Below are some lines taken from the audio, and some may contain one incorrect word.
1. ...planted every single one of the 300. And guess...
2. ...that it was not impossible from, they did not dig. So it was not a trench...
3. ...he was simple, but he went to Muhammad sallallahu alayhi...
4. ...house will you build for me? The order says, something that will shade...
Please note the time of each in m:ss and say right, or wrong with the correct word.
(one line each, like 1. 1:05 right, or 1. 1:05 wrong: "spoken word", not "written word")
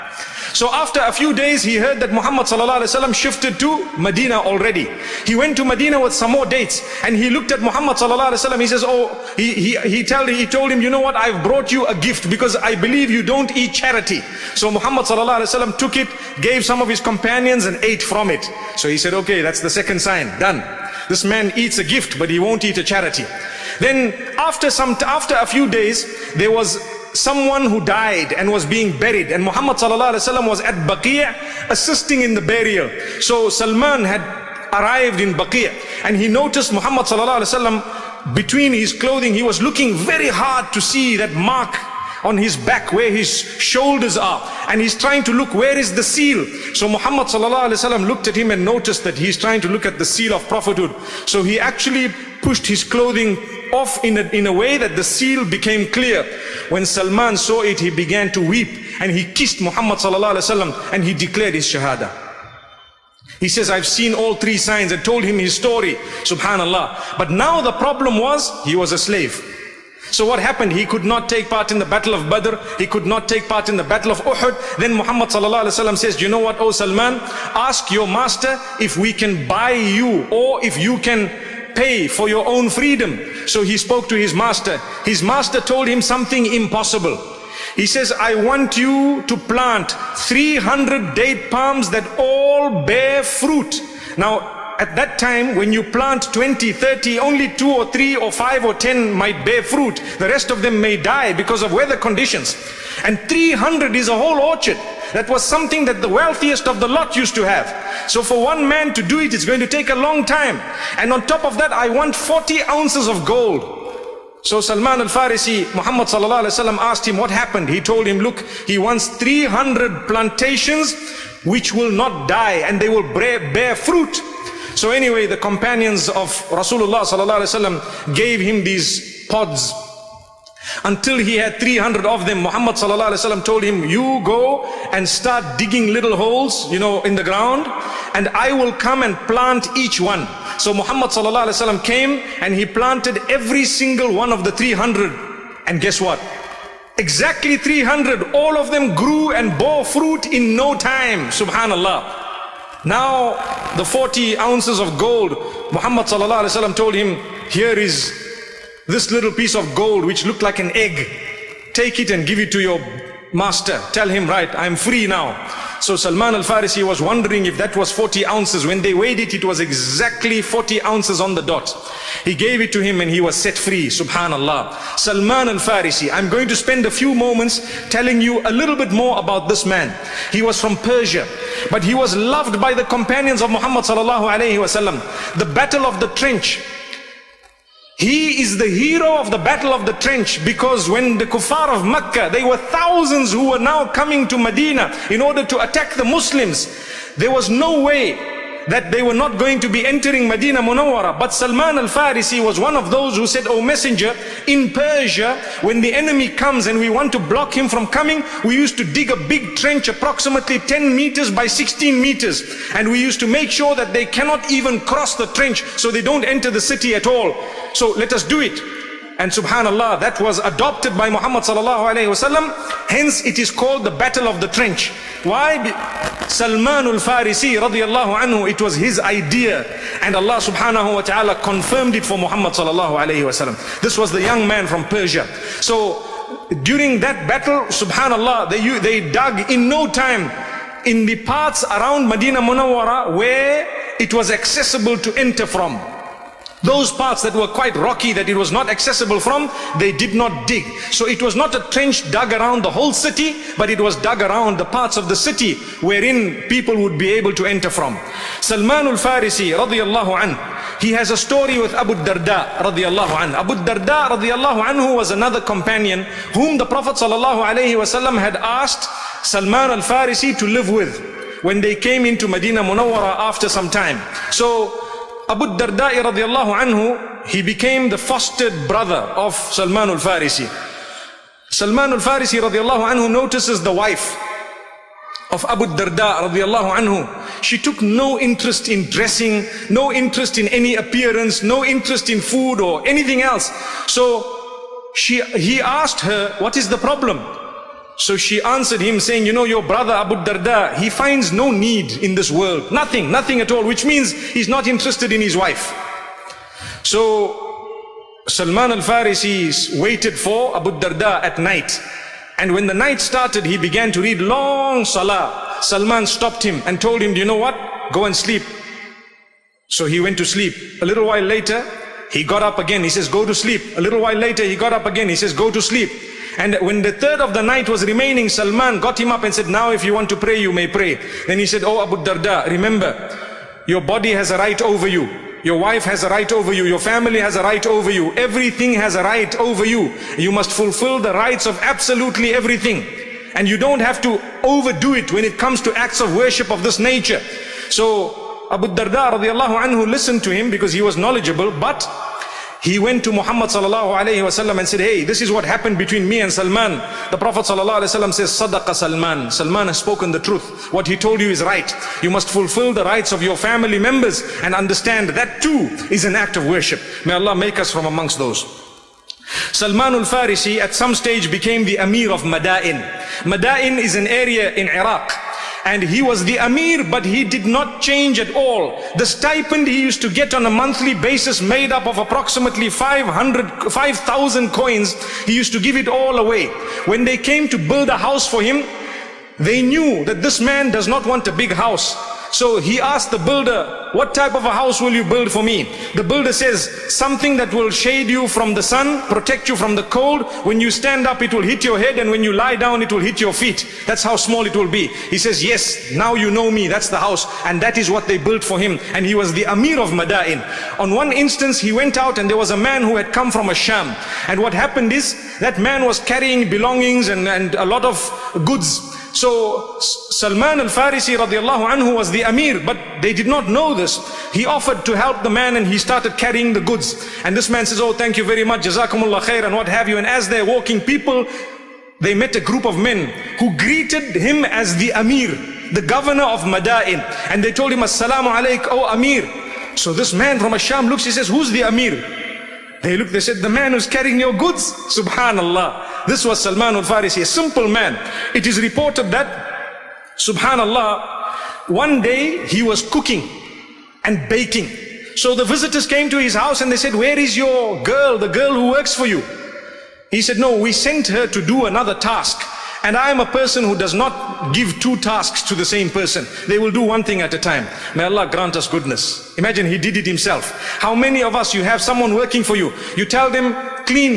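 1. 2:22 right
2. 4:08 wrong: "accessible", not "impossible"
3. 5:50 wrong: "knowledgeable", not "simple"
4. 6:34 wrong: "builder", not "order".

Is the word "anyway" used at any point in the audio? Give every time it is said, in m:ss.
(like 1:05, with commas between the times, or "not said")
2:04.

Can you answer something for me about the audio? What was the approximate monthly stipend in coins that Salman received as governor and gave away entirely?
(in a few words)
5,000 coins.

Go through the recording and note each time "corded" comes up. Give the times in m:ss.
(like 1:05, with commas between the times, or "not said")
not said.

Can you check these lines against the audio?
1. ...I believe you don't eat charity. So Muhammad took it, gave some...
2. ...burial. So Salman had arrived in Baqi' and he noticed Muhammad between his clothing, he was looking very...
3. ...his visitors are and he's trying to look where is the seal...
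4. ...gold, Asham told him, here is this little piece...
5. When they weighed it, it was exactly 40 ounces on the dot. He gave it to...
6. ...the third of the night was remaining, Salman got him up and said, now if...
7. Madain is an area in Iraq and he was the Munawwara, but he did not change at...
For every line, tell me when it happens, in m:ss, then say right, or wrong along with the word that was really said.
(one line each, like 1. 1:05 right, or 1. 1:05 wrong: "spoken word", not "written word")
1. 0:12 right
2. 0:32 right
3. 0:43 wrong: "shoulders", not "visitors"
4. 2:34 wrong: "Muhammad", not "Asham"
5. 2:48 right
6. 5:26 right
7. 6:13 wrong: "Amir", not "Munawwara".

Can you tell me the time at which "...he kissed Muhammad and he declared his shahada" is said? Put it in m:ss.
0:59.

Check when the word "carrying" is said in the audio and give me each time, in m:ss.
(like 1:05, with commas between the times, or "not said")
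6:55, 7:06, 7:23.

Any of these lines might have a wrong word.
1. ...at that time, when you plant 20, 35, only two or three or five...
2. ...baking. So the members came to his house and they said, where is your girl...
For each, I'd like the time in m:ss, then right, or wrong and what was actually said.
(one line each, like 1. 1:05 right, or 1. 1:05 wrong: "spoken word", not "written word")
1. 1:34 wrong: "30", not "35"
2. 7:34 wrong: "visitors", not "members".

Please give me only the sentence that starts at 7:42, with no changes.
And I am a person who does not give two tasks to the same person.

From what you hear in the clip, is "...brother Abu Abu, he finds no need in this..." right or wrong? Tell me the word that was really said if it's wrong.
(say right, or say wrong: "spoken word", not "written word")
wrong: "Darda", not "Abu".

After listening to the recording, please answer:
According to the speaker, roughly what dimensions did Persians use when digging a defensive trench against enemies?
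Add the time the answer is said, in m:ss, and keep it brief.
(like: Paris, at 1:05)
10 by 16 meters, at 3:30.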